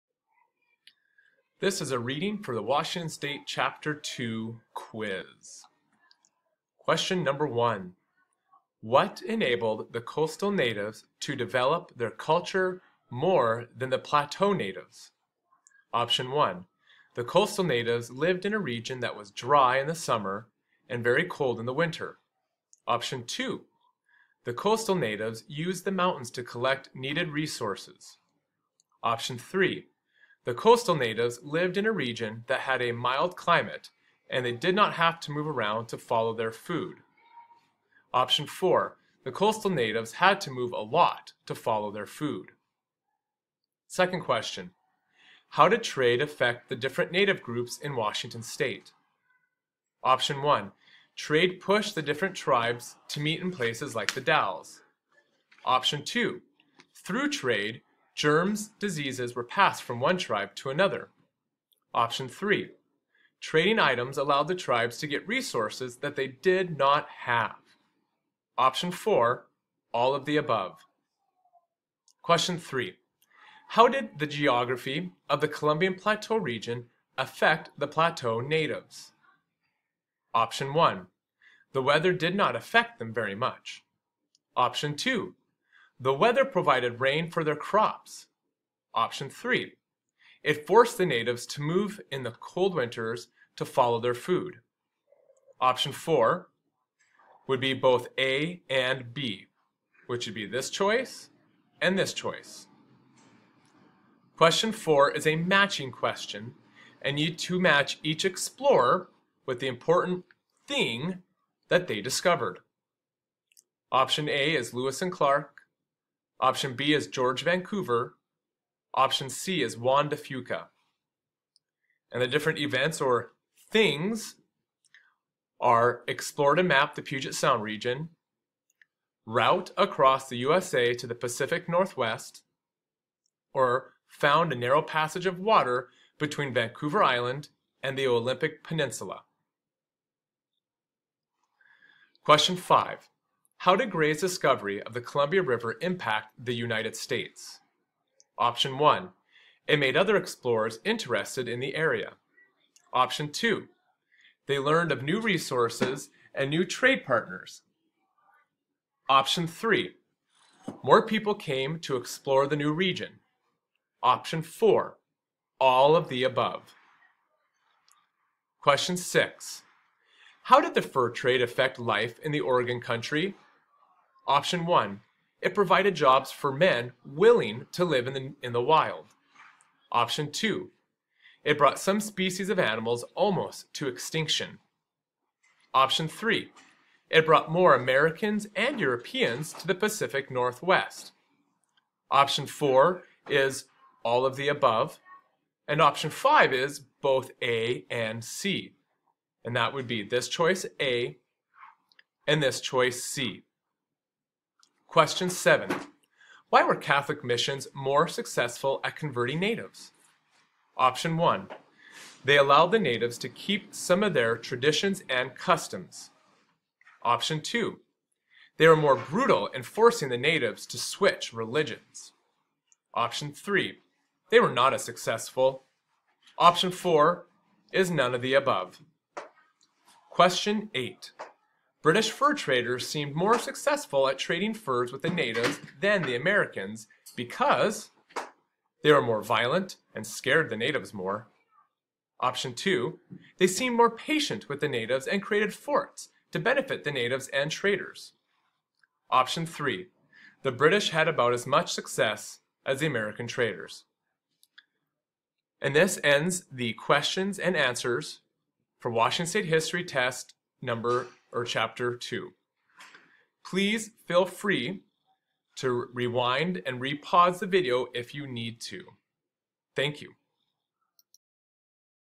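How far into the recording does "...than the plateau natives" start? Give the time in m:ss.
0:13.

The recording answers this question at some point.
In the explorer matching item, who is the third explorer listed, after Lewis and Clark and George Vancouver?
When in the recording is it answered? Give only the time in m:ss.
1:59.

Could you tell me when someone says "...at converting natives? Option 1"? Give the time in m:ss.
3:28.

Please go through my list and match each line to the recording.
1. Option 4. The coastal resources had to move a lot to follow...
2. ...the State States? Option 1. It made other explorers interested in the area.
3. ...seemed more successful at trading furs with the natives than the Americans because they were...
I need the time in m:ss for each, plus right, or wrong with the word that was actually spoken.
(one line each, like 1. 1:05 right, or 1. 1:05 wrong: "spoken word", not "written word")
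1. 0:38 wrong: "natives", not "resources"
2. 2:26 wrong: "United", not "State"
3. 3:52 right.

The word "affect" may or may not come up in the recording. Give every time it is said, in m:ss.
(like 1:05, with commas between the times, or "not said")
0:46, 1:17, 1:22, 2:51.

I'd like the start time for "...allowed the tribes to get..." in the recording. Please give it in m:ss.
1:04.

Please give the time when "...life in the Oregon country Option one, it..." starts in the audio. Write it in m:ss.
2:51.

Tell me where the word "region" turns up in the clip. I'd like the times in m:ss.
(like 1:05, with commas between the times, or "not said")
0:18, 0:31, 1:16, 2:07, 2:42.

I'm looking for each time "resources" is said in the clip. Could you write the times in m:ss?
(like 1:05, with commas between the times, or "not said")
0:27, 1:05, 2:35.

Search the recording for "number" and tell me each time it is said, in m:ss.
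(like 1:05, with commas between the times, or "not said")
0:07, 4:20.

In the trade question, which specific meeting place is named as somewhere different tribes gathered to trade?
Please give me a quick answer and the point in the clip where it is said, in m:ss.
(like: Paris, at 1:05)
The Dalles, at 0:54.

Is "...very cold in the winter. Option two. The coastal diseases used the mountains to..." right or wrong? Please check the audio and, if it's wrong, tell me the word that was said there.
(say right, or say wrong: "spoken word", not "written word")
wrong: "natives", not "diseases".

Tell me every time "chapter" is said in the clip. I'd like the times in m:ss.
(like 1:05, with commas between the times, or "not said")
0:03, 4:21.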